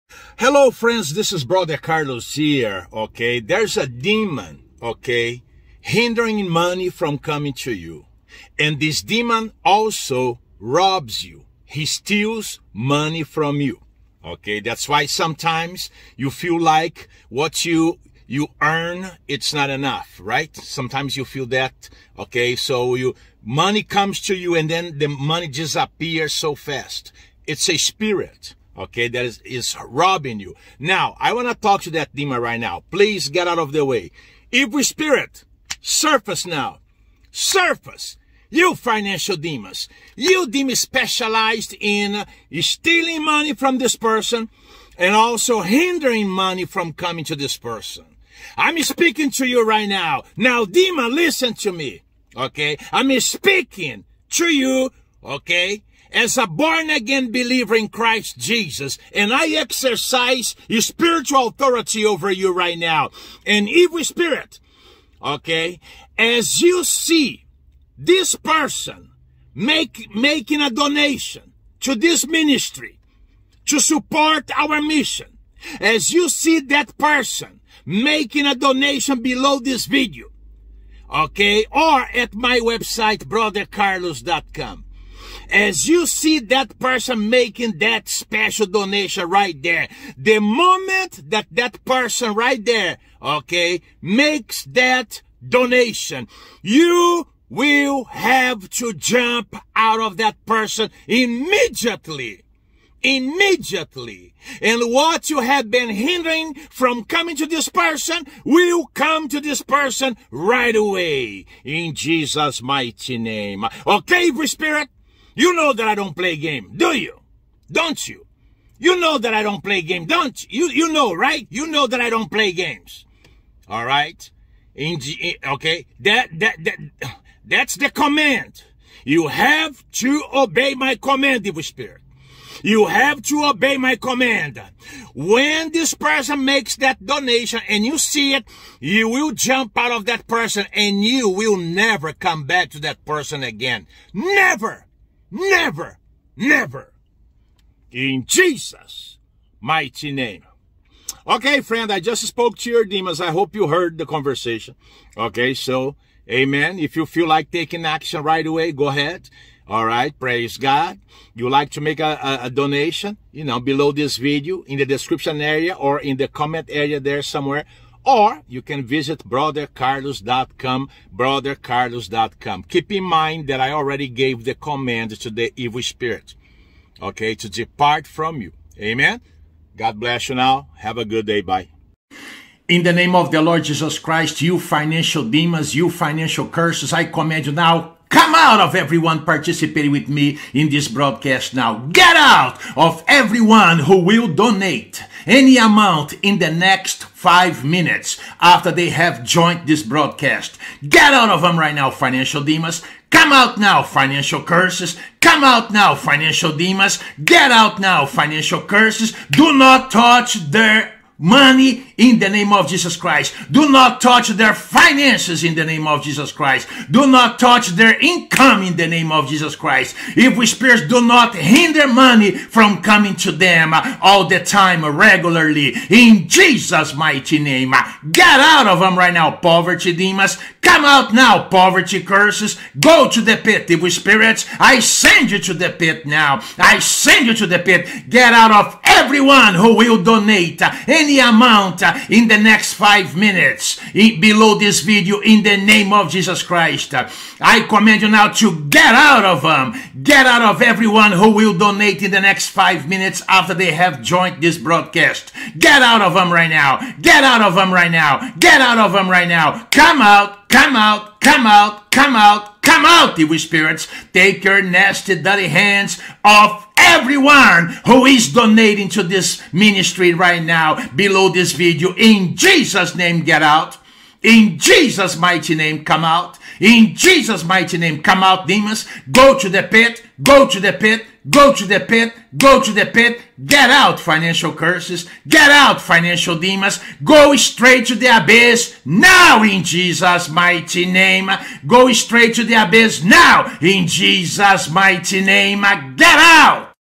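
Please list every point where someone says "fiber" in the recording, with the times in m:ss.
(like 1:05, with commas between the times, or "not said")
not said.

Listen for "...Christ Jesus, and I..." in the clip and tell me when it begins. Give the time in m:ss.
0:57.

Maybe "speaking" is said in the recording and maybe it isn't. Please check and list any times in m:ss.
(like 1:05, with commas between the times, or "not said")
0:48, 0:53.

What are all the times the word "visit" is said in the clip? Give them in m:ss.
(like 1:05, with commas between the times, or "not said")
2:48.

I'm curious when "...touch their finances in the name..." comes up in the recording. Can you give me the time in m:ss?
3:34.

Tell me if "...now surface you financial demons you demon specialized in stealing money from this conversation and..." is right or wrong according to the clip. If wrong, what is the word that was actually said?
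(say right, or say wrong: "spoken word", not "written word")
wrong: "person", not "conversation".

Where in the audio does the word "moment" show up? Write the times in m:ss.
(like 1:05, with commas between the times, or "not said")
1:30.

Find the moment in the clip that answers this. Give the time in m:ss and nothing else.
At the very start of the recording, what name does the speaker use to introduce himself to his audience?
0:01.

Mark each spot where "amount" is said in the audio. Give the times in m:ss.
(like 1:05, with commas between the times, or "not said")
3:15, 4:01.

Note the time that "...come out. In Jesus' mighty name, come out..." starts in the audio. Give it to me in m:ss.
4:35.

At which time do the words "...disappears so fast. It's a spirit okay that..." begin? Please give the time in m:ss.
0:25.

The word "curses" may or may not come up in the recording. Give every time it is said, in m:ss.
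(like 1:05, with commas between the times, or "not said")
3:06, 3:24, 3:28, 3:52, 4:44.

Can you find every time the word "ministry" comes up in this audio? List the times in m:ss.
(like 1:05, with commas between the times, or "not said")
1:12, 4:29.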